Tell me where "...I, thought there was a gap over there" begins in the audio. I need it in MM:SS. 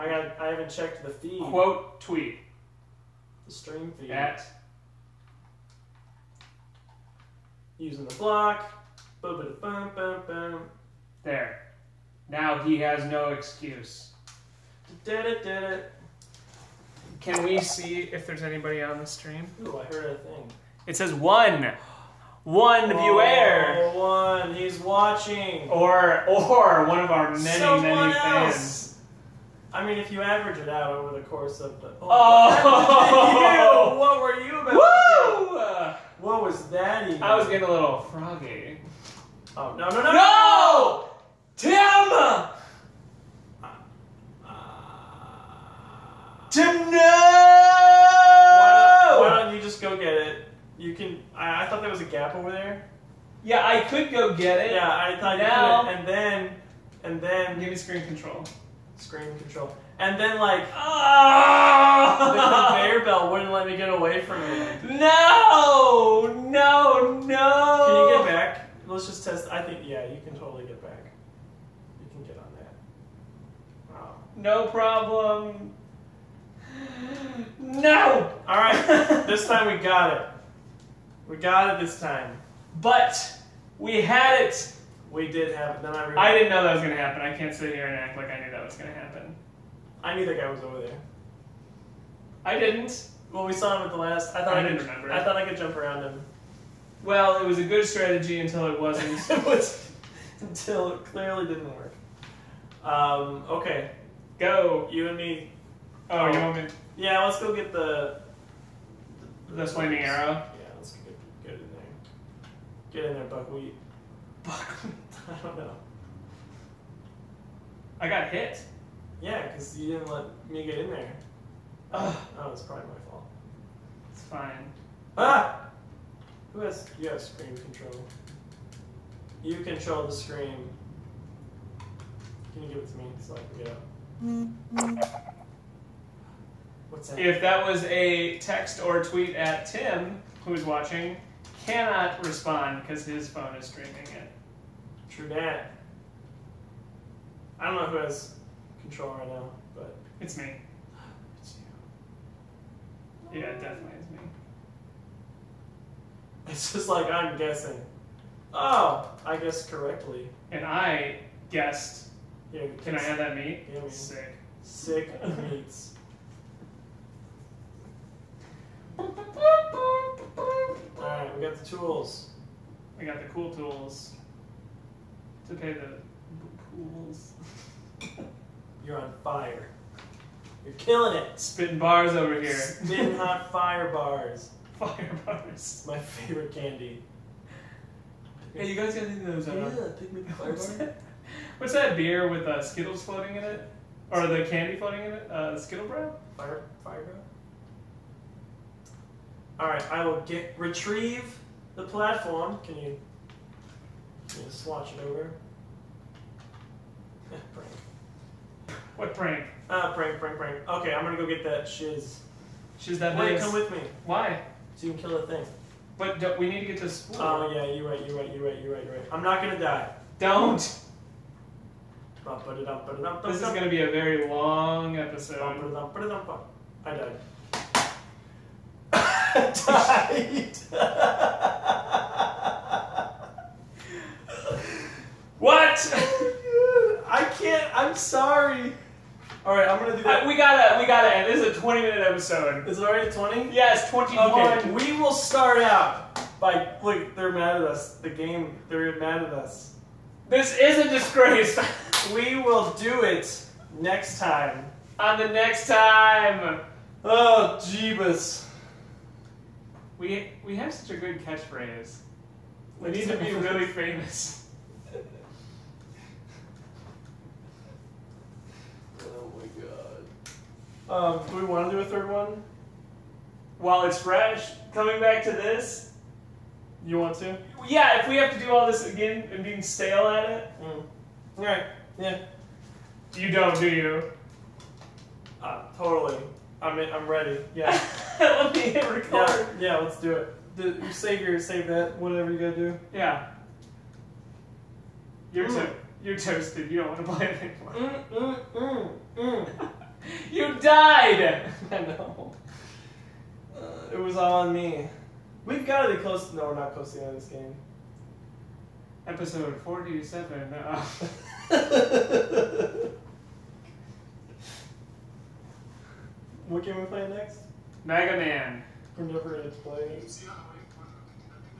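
00:51.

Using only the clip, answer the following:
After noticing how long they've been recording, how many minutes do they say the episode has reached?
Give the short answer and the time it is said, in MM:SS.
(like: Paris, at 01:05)
21, at 04:03.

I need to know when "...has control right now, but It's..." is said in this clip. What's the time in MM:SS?
02:28.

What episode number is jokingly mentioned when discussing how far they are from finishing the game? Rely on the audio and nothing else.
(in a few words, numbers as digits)
47.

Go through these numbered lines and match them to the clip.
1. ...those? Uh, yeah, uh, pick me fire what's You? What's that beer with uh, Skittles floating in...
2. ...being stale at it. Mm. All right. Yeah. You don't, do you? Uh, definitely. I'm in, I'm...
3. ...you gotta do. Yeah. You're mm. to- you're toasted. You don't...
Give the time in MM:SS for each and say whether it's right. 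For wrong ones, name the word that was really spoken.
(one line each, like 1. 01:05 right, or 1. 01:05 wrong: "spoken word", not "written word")
1. 03:09 wrong: "That", not "You"
2. 04:39 wrong: "totally", not "definitely"
3. 04:52 right.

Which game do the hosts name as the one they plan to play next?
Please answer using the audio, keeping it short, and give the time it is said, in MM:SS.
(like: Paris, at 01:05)
Mega Man, at 05:17.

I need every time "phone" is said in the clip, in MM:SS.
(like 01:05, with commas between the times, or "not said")
02:23.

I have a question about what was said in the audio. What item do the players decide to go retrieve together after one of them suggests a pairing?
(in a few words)
flaming arrow.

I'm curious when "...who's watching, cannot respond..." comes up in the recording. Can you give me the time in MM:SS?
02:20.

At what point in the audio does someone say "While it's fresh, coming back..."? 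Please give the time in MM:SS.
04:33.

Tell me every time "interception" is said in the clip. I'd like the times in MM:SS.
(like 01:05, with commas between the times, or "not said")
not said.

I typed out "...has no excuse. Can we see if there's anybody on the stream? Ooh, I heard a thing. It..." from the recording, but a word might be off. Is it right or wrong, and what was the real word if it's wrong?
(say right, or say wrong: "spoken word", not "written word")
right.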